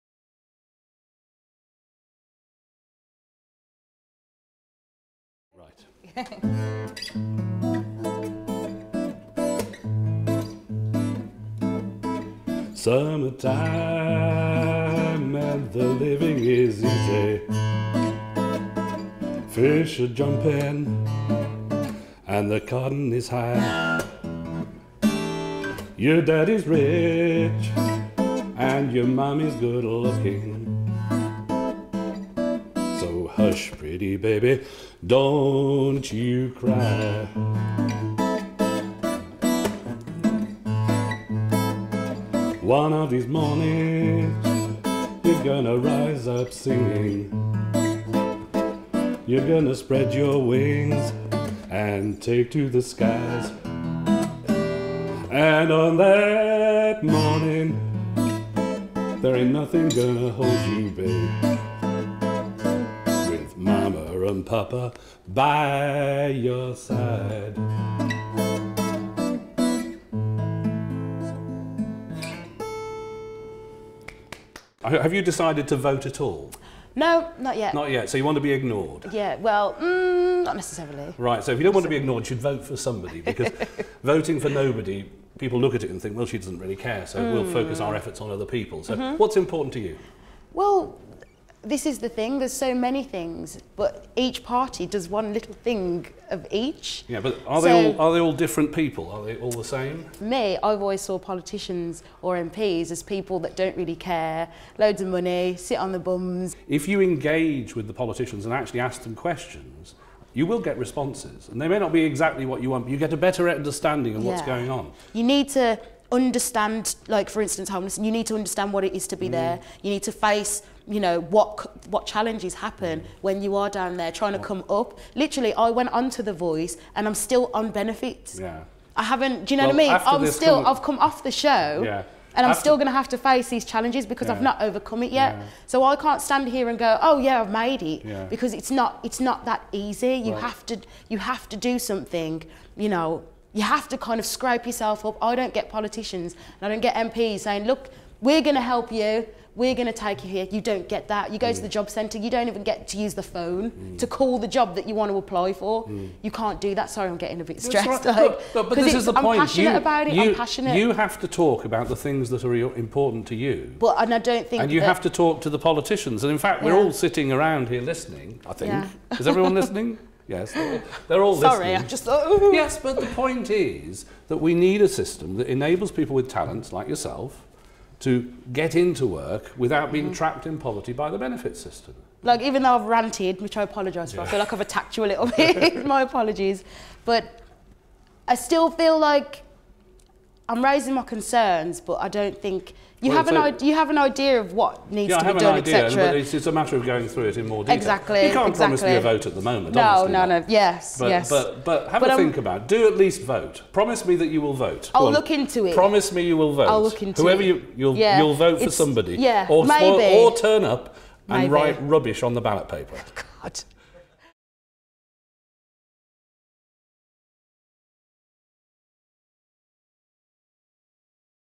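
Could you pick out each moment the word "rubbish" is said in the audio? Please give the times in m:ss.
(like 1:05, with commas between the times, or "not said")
3:31.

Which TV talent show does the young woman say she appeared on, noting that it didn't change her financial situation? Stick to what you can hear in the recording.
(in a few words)
The Voice.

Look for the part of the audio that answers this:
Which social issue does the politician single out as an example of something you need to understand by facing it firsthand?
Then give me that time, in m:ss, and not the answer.
1:57.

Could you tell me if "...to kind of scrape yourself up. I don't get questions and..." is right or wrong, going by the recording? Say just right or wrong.
wrong.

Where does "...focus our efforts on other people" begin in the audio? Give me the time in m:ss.
1:27.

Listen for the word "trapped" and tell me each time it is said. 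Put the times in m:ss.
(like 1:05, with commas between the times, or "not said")
3:00.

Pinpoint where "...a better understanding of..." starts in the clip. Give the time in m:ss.
1:53.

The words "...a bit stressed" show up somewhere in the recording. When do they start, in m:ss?
2:37.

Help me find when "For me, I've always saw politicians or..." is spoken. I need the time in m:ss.
1:40.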